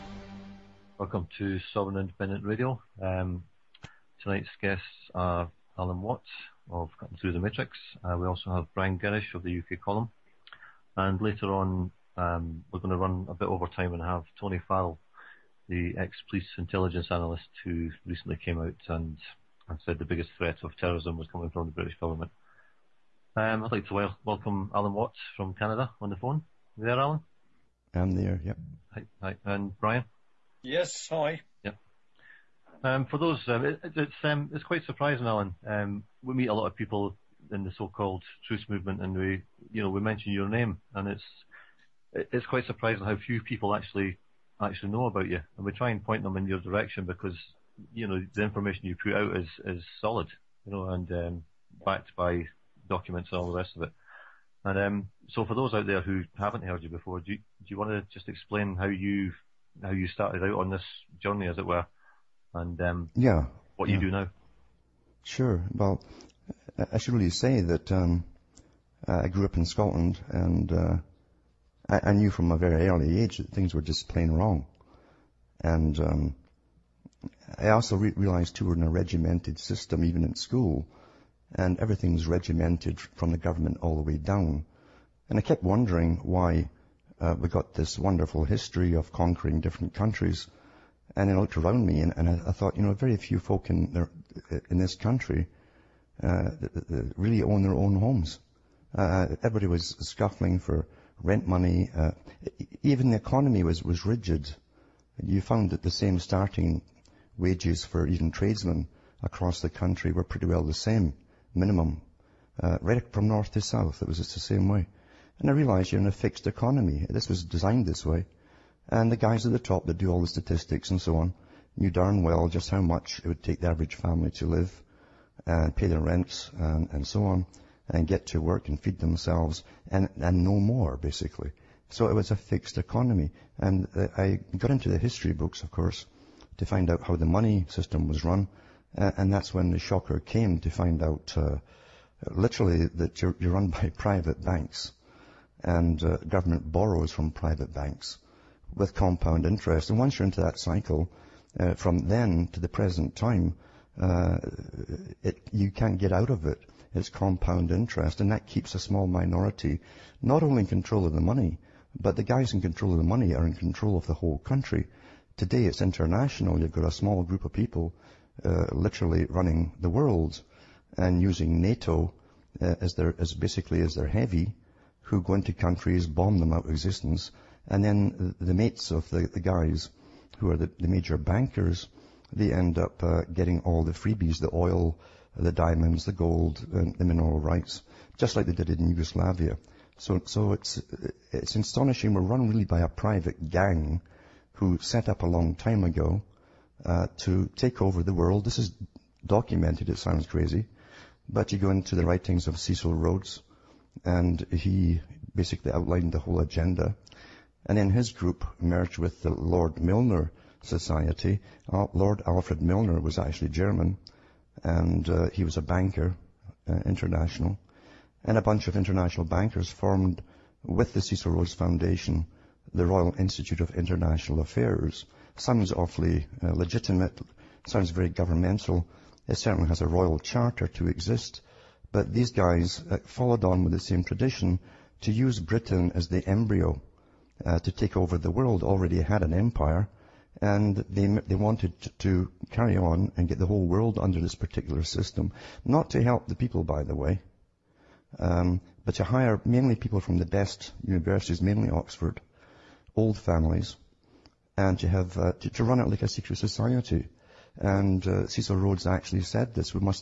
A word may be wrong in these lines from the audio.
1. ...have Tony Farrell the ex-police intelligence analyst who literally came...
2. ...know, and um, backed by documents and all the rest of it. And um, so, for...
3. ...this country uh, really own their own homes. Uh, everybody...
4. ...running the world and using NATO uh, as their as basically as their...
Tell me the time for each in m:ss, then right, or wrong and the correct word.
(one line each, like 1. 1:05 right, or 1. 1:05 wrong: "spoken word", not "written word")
1. 0:14 wrong: "recently", not "literally"
2. 0:50 right
3. 1:34 right
4. 2:49 right.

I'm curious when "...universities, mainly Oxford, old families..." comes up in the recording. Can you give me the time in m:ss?
4:10.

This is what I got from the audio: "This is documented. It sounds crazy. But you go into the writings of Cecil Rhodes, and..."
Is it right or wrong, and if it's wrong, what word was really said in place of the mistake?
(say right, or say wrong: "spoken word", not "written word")
right.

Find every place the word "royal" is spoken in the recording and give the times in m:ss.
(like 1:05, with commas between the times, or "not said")
3:42, 3:49.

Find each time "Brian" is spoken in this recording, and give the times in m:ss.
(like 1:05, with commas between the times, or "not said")
0:08, 0:29.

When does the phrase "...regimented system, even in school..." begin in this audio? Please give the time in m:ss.
1:18.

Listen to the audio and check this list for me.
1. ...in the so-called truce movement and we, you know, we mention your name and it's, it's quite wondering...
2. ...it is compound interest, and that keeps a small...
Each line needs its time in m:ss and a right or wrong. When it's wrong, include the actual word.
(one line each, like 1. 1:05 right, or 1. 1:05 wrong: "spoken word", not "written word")
1. 0:37 wrong: "surprising", not "wondering"
2. 2:36 right.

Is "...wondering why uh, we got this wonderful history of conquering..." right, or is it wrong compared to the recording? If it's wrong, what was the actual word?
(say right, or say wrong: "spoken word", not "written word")
right.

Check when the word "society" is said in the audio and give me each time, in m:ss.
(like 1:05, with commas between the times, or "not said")
3:30, 4:16.